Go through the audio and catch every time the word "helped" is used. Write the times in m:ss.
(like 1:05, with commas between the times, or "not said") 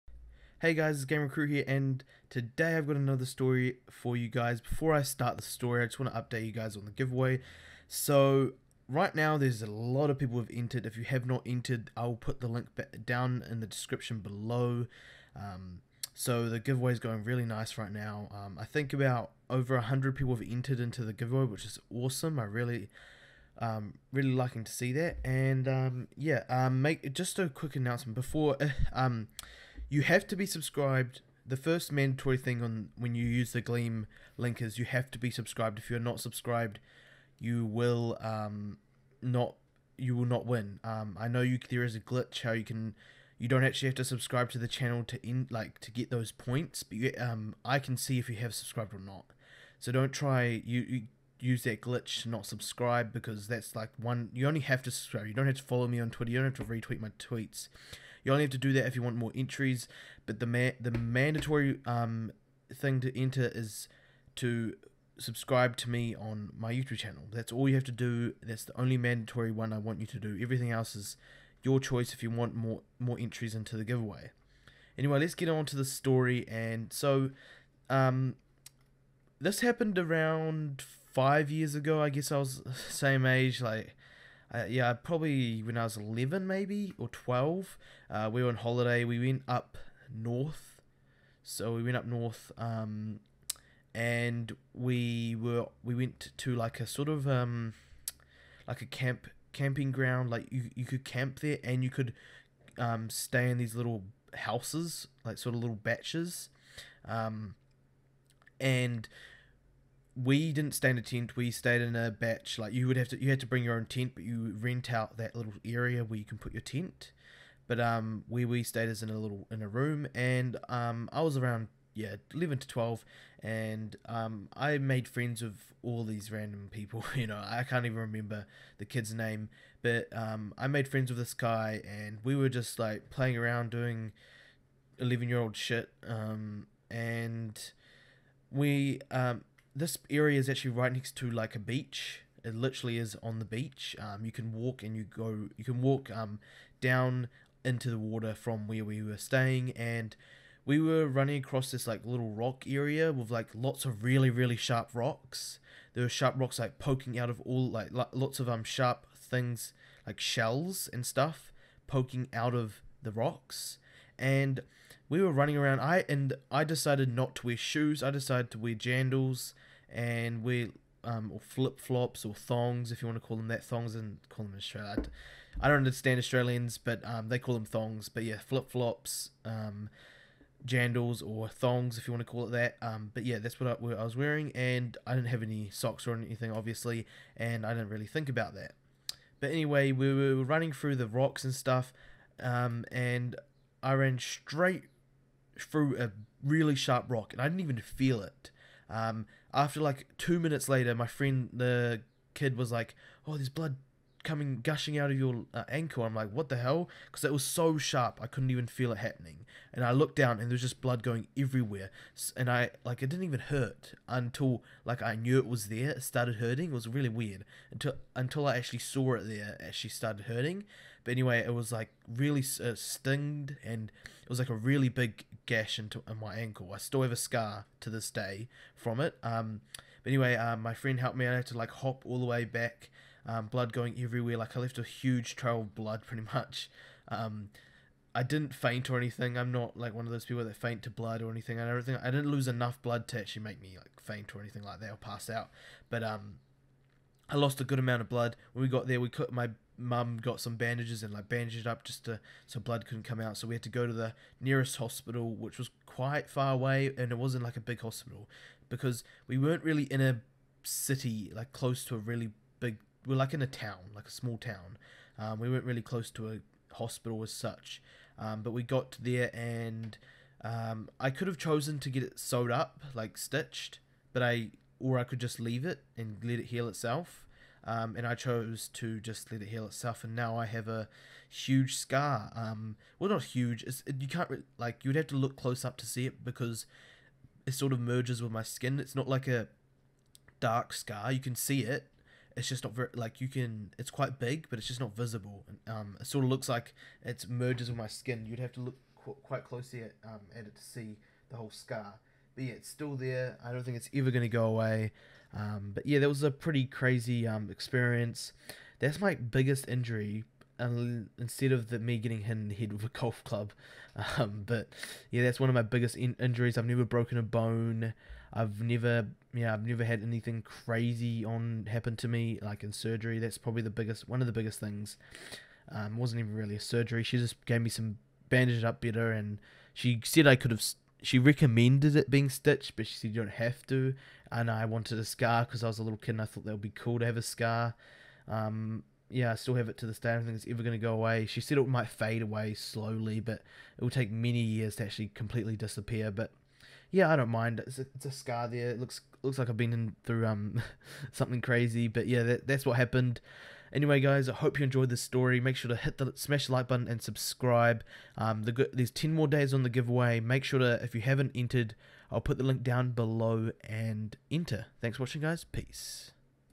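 3:50.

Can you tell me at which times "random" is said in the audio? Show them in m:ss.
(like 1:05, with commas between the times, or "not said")
2:06.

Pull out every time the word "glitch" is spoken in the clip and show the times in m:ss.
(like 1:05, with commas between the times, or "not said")
0:41, 0:51.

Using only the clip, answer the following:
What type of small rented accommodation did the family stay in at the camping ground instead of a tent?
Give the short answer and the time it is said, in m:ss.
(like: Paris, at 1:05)
a bach, at 1:52.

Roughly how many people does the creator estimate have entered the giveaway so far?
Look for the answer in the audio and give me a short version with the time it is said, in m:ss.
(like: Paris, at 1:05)
over 100, at 0:19.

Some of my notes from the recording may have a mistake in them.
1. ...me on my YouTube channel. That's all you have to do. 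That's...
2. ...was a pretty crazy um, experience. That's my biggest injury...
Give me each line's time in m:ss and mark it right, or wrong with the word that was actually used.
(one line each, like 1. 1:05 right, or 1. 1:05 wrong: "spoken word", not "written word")
1. 1:05 right
2. 5:06 right.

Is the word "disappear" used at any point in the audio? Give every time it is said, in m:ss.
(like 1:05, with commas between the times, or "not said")
5:45.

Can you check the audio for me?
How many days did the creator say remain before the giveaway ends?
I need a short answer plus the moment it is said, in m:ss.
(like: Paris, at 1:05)
10, at 5:58.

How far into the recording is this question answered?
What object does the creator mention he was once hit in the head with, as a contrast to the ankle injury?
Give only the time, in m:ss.
5:12.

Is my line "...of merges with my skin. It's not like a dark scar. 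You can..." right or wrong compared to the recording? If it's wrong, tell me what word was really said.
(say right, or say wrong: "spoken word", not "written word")
right.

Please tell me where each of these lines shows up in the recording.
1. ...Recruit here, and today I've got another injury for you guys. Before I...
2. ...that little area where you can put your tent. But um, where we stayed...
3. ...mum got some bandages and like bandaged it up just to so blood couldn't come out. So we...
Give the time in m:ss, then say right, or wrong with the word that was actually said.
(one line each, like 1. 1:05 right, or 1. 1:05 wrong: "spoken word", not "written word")
1. 0:01 wrong: "story", not "injury"
2. 1:55 right
3. 4:09 right.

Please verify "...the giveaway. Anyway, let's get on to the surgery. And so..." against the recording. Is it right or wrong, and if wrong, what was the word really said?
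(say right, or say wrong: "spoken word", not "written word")
wrong: "story", not "surgery".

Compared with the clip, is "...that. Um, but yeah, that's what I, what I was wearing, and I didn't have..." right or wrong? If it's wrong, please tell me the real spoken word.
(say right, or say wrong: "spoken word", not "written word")
right.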